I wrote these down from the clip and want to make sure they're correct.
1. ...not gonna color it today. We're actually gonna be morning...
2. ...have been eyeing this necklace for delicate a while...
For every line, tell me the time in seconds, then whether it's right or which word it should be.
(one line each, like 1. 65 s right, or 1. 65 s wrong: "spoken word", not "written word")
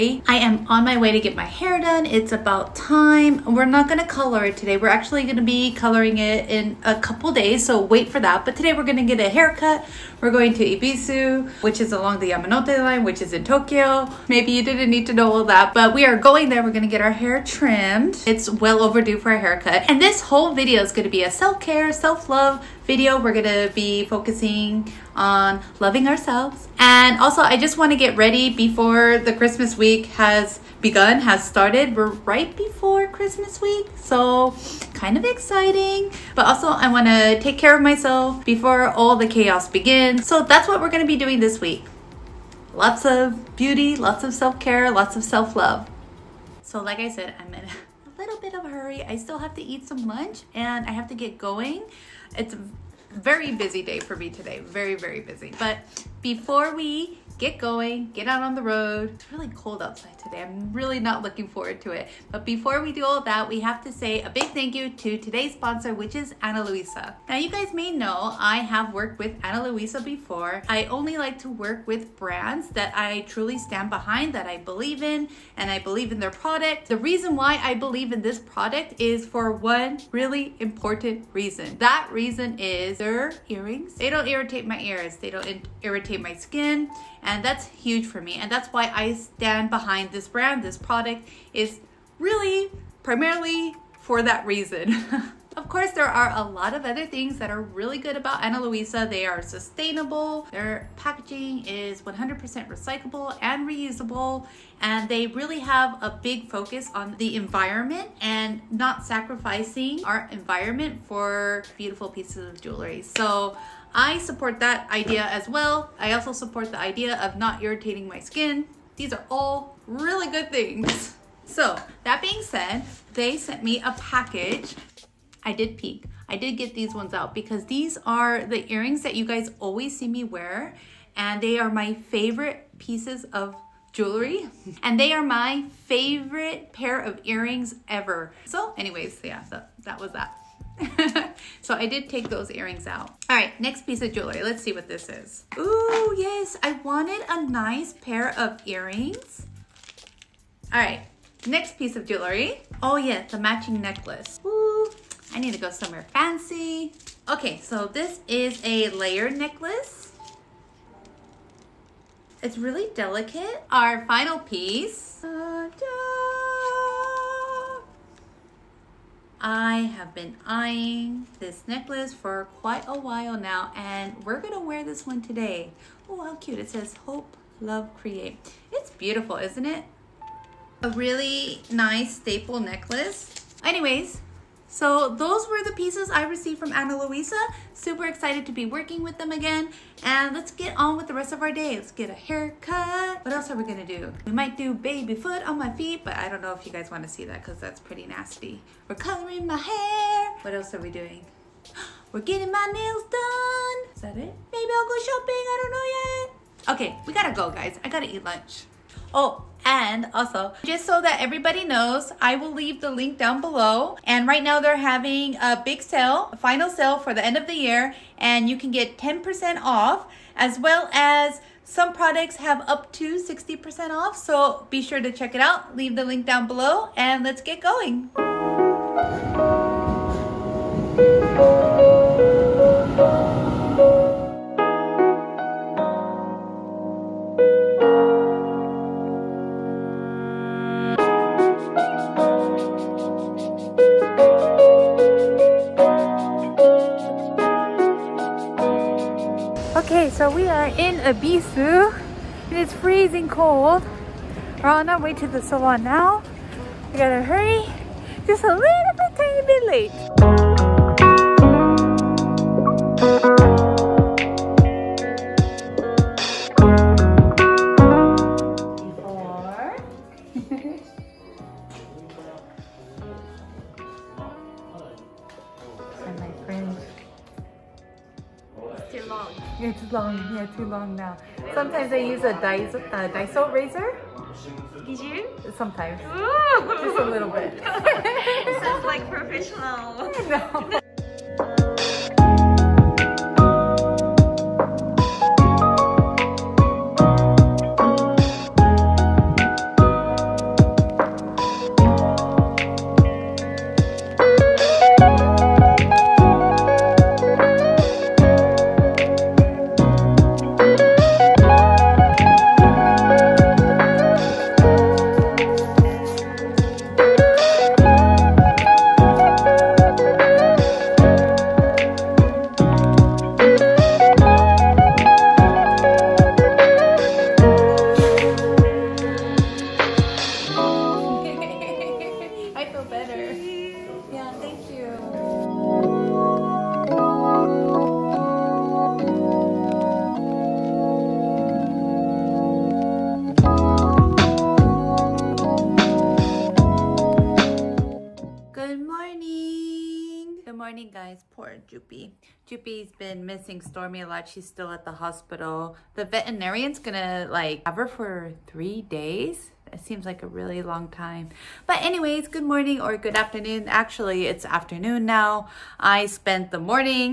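1. 3 s wrong: "coloring", not "morning"
2. 169 s wrong: "quite", not "delicate".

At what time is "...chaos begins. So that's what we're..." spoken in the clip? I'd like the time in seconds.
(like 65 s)
39 s.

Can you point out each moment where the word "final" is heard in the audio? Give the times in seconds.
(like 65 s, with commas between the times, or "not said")
164 s, 216 s.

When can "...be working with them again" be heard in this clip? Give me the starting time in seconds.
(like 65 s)
188 s.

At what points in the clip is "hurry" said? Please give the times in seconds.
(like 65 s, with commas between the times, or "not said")
48 s, 257 s.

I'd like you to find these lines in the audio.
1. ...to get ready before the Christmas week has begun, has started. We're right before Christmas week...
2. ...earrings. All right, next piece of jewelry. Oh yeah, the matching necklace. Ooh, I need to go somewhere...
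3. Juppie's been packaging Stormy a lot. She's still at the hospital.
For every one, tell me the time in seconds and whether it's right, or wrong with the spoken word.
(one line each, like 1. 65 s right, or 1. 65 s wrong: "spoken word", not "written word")
1. 27 s right
2. 148 s right
3. 352 s wrong: "missing", not "packaging".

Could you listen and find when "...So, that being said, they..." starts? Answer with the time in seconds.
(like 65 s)
121 s.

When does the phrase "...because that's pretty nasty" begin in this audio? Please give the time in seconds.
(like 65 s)
197 s.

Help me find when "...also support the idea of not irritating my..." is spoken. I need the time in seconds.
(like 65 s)
116 s.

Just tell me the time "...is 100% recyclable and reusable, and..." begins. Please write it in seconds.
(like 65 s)
101 s.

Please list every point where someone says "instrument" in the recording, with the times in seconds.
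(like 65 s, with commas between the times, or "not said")
not said.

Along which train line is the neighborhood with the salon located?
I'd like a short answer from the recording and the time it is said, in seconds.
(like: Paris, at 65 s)
Yamanote line, at 12 s.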